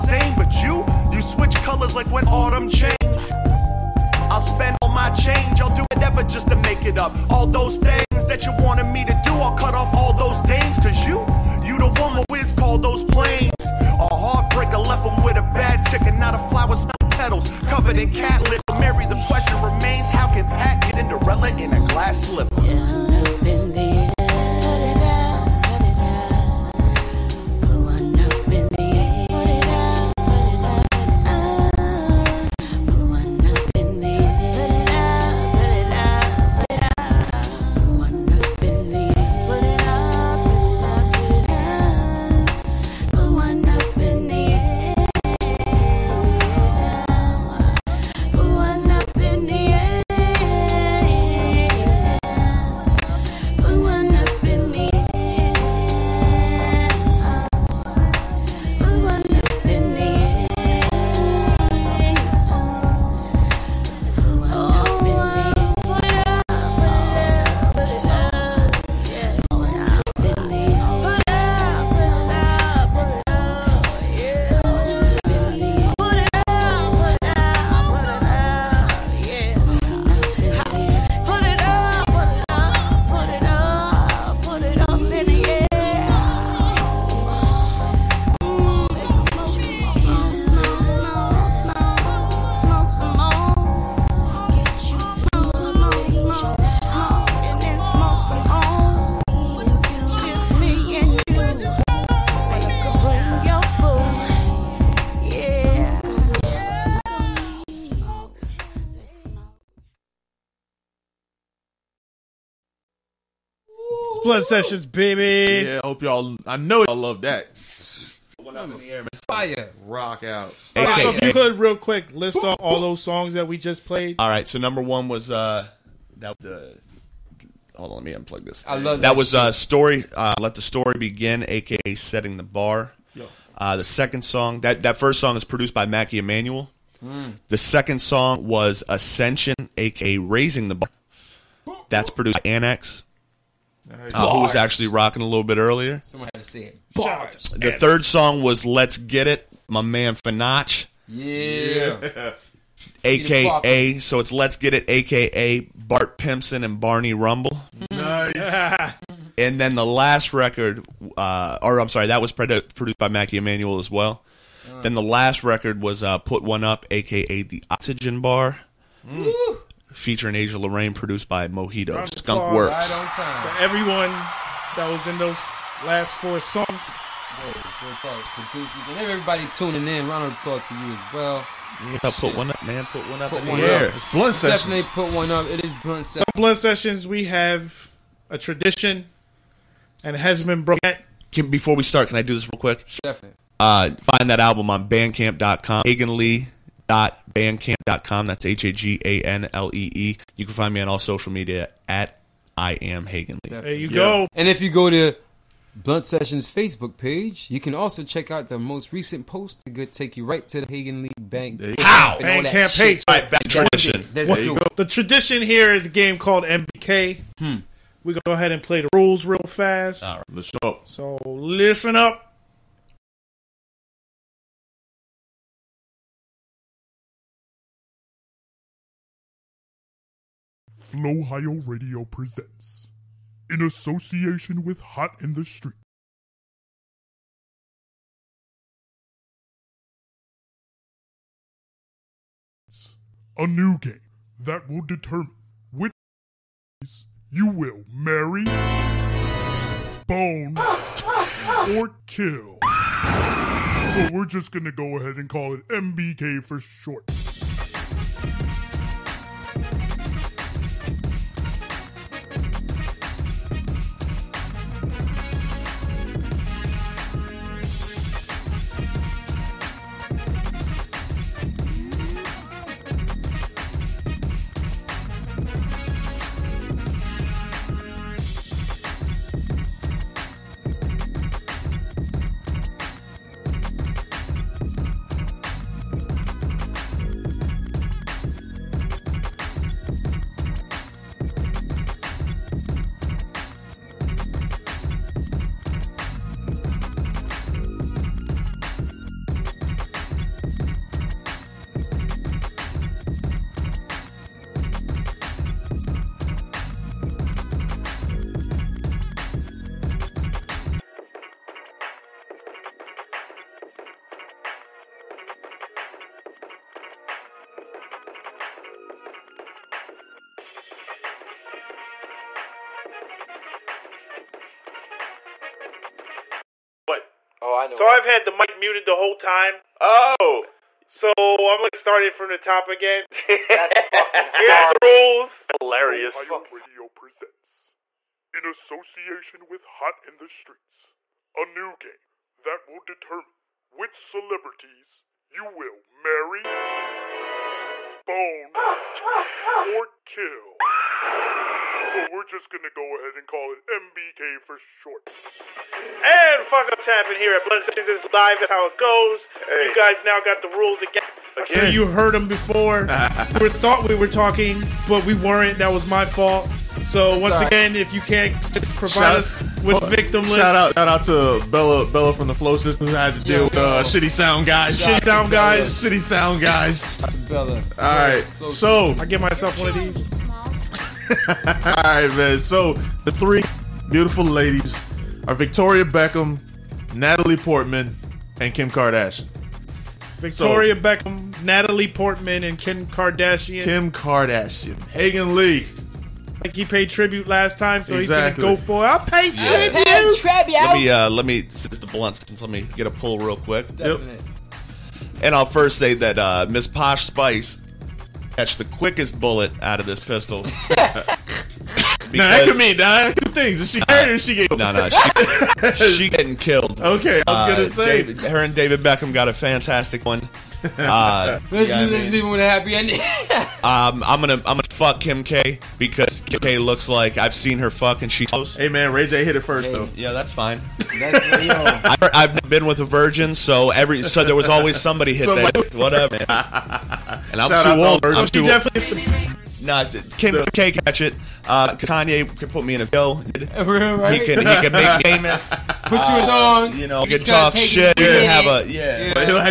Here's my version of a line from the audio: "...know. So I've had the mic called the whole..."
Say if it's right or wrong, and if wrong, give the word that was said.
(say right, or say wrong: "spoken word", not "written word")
wrong: "muted", not "called".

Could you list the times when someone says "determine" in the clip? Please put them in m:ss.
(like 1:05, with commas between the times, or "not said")
4:04, 5:42.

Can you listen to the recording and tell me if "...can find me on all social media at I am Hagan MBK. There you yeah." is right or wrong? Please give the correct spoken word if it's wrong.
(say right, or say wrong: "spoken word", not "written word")
wrong: "Lee", not "MBK".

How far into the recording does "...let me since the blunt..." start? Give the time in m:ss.
6:41.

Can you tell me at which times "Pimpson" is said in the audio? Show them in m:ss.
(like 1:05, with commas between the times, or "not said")
2:36.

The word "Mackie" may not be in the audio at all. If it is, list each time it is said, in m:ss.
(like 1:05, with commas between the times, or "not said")
2:15, 2:43.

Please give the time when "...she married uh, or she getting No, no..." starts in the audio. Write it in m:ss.
6:53.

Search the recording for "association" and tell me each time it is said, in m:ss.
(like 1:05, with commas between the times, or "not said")
3:53, 5:38.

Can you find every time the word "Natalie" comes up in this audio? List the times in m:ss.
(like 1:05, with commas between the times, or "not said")
6:26, 6:31.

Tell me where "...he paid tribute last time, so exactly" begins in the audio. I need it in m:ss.
6:36.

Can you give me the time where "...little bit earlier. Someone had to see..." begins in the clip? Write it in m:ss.
2:25.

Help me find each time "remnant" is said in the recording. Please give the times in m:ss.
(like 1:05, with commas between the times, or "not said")
not said.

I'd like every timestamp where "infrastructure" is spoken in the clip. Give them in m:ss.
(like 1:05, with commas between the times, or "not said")
not said.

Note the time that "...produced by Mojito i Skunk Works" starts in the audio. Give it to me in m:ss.
2:50.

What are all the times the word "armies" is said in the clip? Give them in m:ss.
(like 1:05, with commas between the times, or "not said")
not said.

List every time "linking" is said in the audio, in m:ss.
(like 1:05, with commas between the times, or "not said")
not said.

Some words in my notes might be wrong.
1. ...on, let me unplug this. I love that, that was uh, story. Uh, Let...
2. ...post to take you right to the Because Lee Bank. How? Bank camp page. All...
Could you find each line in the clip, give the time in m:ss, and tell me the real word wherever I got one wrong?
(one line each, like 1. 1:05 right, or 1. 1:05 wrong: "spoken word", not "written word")
1. 2:07 right
2. 3:29 wrong: "Hagan", not "Because".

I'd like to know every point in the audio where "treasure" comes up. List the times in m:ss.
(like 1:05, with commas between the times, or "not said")
not said.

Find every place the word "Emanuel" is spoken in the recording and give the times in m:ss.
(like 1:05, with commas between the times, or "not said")
2:16, 2:43.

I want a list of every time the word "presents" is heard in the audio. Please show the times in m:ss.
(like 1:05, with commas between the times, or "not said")
3:52, 5:36.